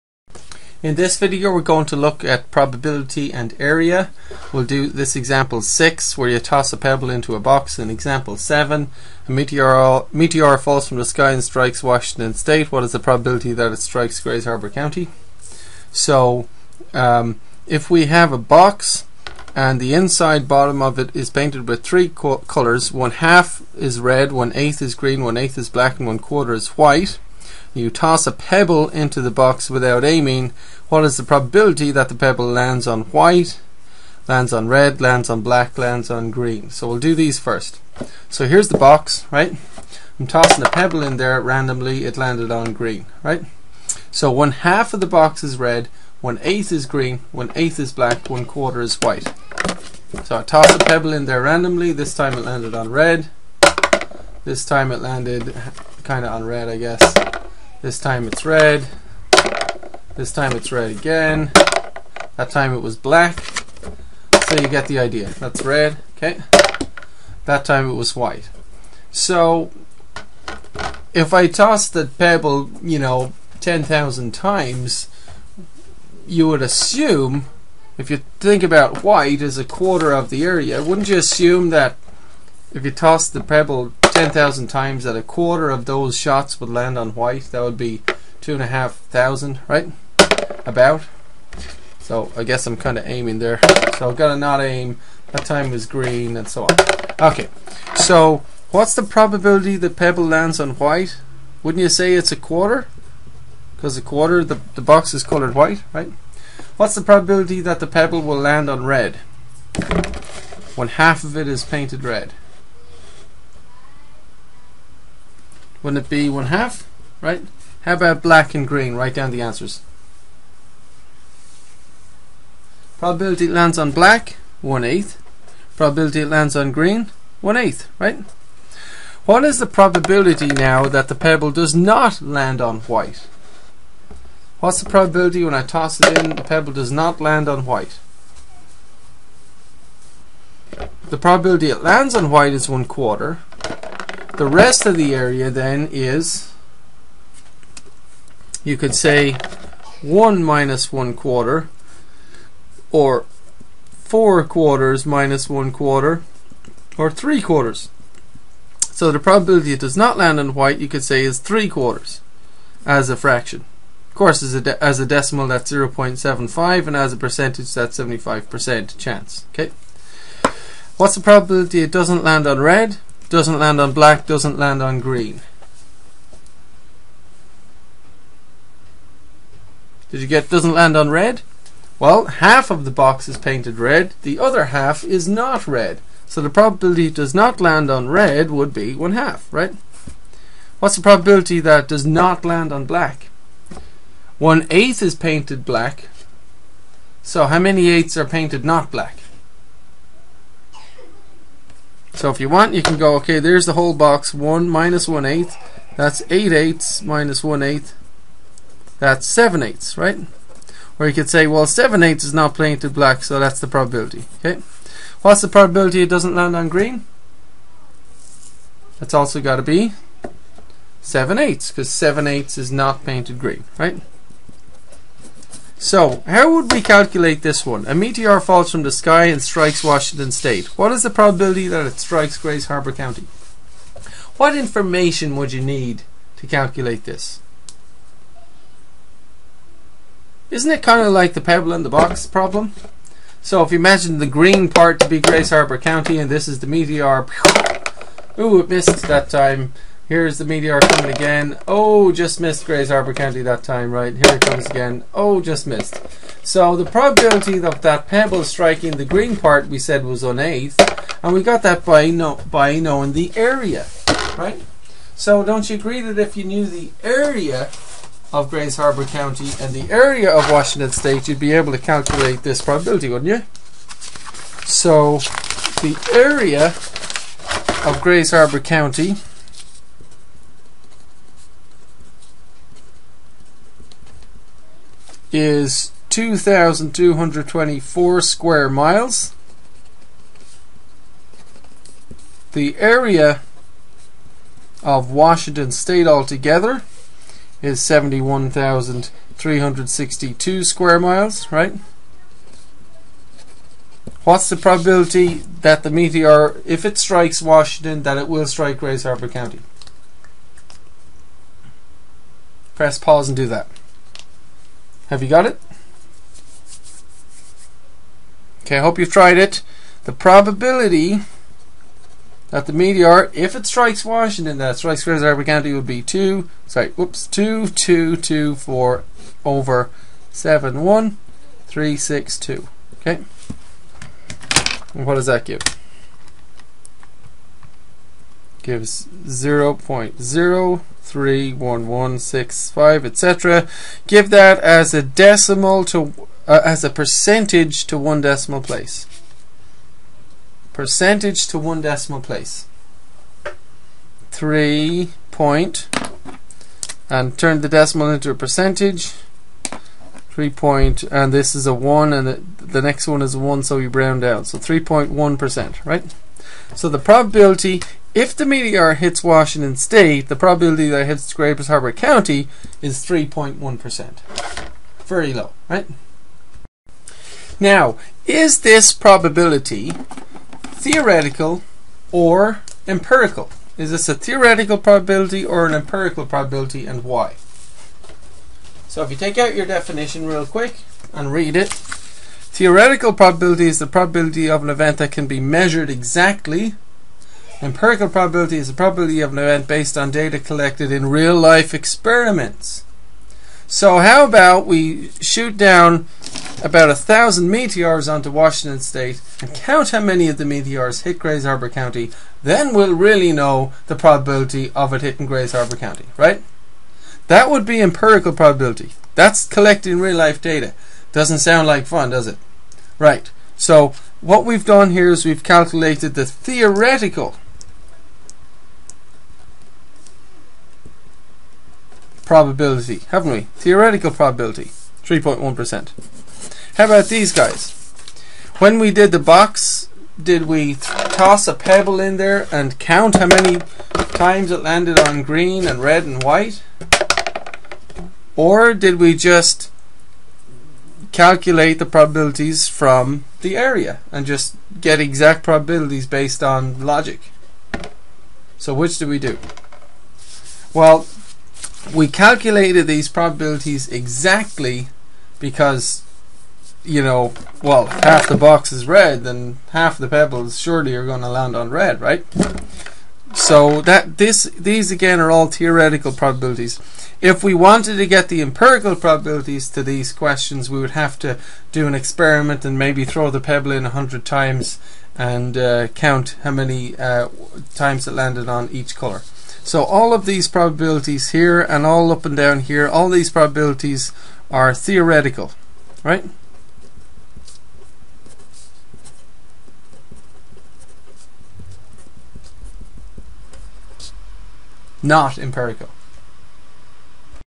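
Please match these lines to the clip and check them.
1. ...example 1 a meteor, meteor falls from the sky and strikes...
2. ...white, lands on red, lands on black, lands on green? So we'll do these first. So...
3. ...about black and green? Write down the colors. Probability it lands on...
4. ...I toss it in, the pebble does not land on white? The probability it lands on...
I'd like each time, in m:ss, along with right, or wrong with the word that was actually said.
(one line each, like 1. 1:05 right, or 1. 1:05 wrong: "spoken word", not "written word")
1. 0:07 wrong: "7", not "1"
2. 0:33 right
3. 1:57 wrong: "answers", not "colors"
4. 2:15 right.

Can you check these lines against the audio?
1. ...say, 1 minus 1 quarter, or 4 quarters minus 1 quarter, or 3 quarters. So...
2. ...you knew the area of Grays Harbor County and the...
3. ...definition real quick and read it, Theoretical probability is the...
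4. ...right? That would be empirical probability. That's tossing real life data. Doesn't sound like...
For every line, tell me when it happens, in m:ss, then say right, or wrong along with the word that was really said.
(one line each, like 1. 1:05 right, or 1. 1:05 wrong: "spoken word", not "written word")
1. 2:28 right
2. 4:26 right
3. 6:29 right
4. 6:56 wrong: "collecting", not "tossing".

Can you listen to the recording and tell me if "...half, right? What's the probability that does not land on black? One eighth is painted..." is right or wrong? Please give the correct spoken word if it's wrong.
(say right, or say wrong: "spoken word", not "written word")
right.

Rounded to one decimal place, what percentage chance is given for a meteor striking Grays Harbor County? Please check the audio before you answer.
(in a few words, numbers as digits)
3.1%.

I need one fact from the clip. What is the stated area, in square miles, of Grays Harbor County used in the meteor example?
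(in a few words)
2,224 square miles.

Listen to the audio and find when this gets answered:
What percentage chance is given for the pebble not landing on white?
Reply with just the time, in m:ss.
2:47.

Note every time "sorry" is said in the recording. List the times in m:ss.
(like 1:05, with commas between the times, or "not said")
5:26.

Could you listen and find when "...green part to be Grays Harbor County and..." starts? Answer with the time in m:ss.
4:04.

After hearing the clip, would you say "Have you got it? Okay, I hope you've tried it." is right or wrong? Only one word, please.
right.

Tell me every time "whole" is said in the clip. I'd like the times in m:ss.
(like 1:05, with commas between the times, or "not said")
3:23.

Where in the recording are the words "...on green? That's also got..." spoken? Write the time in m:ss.
3:36.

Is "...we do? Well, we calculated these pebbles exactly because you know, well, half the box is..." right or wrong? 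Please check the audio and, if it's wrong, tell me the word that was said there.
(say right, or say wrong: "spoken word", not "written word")
wrong: "probabilities", not "pebbles".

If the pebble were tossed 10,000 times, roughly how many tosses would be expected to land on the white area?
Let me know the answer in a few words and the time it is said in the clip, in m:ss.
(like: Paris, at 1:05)
2,500, at 1:28.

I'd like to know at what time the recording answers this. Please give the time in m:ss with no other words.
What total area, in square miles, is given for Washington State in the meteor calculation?
4:57.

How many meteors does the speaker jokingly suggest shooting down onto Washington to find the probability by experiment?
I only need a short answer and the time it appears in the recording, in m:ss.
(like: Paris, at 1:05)
about a thousand, at 6:46.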